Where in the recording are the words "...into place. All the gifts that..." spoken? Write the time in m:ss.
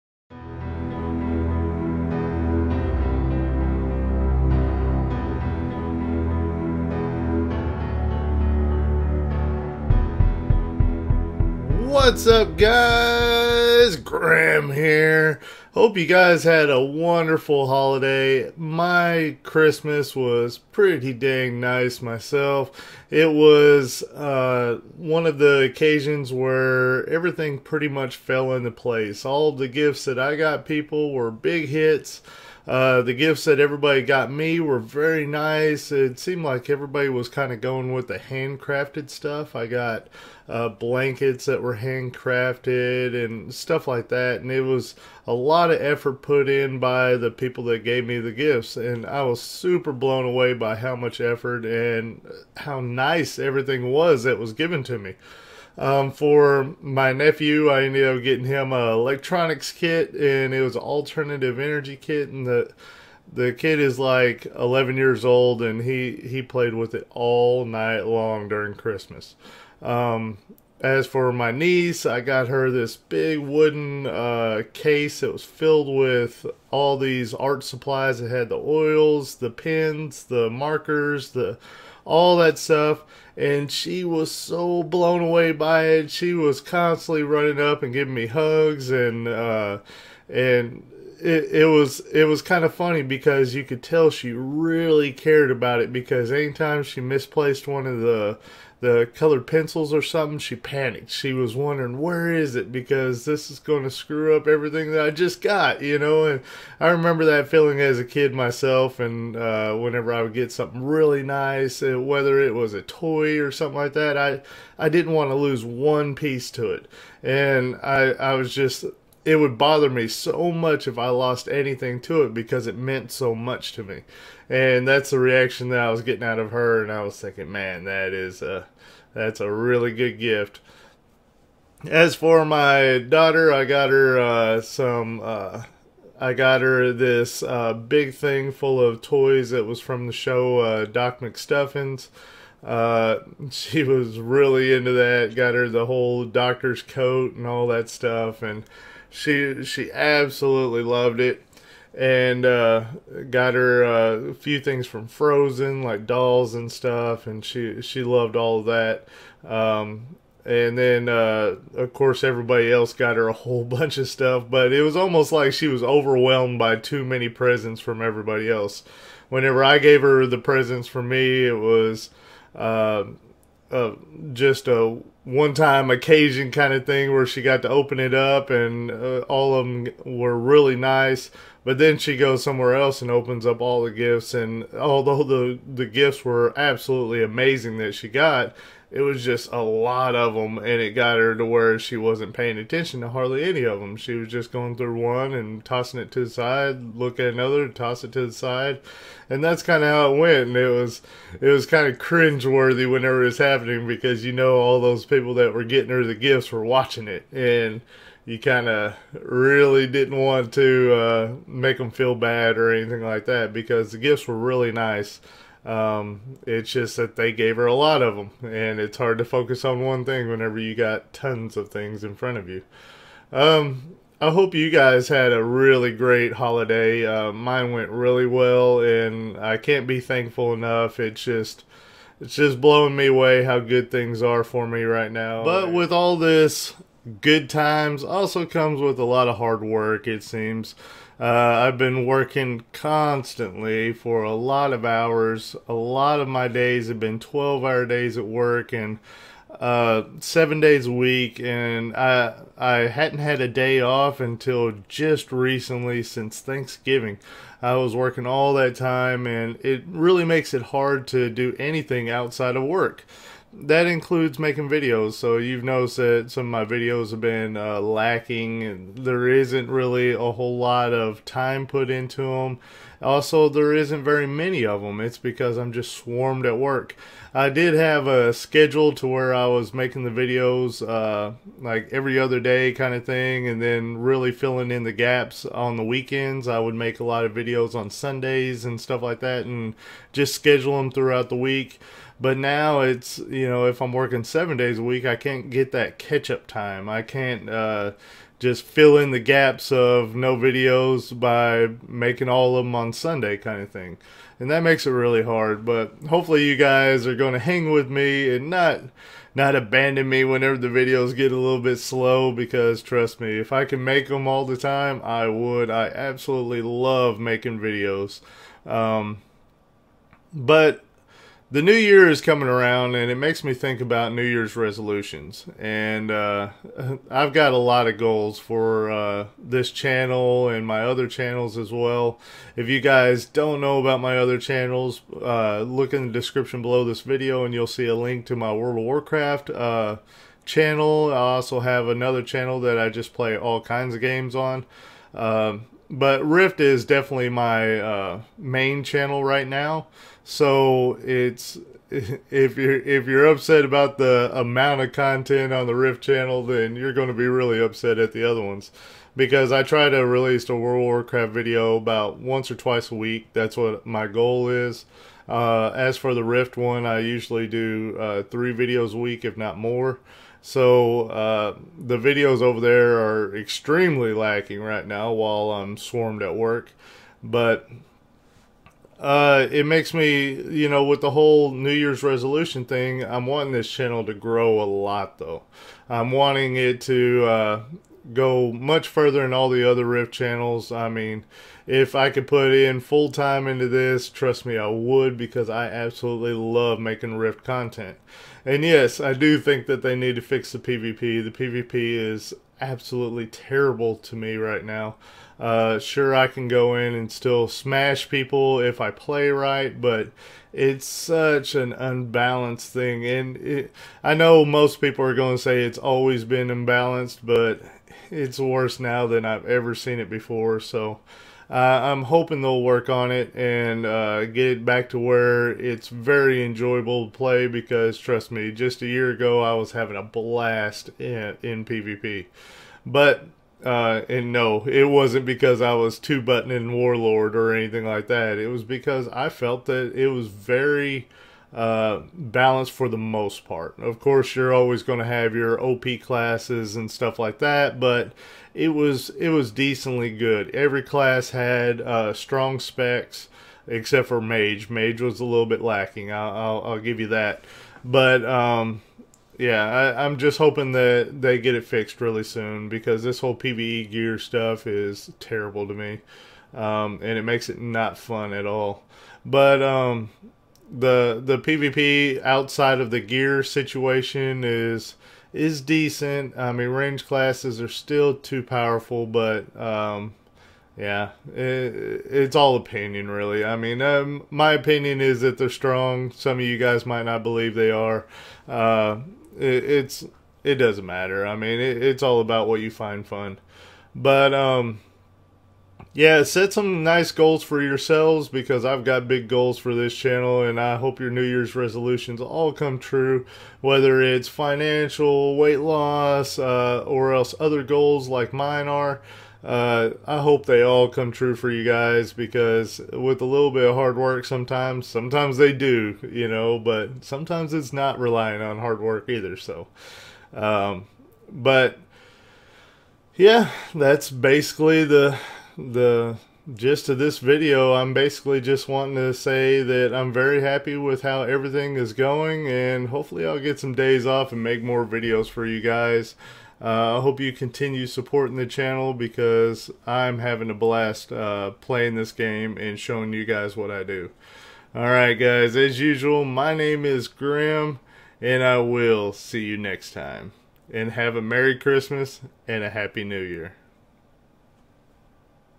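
0:28.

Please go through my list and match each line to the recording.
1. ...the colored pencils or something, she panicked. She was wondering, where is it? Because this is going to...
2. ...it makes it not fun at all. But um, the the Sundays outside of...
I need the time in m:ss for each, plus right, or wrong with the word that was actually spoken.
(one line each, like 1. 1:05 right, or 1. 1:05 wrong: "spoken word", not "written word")
1. 1:38 right
2. 7:47 wrong: "PvP", not "Sundays".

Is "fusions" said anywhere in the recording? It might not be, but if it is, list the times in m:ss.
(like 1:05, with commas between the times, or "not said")
not said.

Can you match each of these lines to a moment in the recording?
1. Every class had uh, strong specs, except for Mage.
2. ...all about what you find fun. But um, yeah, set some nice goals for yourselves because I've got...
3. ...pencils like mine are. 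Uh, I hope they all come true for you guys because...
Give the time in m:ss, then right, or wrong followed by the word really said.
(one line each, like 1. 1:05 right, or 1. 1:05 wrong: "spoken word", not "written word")
1. 7:30 right
2. 8:12 right
3. 8:27 wrong: "goals", not "pencils".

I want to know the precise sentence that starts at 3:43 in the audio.
Um, I hope you guys had a really great holiday.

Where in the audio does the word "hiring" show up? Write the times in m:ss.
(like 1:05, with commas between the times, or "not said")
not said.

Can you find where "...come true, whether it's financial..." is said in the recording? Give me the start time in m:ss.
8:22.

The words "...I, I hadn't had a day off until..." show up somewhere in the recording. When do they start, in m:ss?
4:11.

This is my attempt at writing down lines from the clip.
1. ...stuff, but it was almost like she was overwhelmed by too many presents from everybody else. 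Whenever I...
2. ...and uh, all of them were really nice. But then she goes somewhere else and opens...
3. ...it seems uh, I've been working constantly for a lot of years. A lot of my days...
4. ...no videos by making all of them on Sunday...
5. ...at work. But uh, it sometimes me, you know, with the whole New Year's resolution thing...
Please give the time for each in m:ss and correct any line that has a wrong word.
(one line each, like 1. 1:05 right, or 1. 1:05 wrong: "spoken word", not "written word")
1. 2:44 right
2. 2:58 right
3. 4:00 wrong: "hours", not "years"
4. 5:00 right
5. 6:16 wrong: "makes", not "sometimes".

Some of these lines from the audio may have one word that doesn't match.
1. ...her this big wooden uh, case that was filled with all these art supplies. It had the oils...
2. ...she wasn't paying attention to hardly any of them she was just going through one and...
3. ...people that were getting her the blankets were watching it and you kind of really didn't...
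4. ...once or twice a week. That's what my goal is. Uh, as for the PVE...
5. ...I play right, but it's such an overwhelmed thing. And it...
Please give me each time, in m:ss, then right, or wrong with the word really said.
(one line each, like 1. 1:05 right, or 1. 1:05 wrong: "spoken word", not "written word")
1. 1:12 right
2. 3:11 right
3. 3:25 wrong: "gifts", not "blankets"
4. 6:02 wrong: "Rift", not "PVE"
5. 6:48 wrong: "unbalanced", not "overwhelmed".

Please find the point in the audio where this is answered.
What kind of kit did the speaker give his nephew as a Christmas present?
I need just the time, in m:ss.
1:00.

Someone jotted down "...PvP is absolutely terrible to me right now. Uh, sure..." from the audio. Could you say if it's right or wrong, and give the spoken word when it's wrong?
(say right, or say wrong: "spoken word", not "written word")
right.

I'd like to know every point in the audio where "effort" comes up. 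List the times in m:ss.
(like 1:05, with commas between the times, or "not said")
0:45, 0:51.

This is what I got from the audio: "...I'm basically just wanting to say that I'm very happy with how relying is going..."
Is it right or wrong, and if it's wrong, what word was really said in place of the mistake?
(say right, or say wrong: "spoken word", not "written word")
wrong: "everything", not "relying".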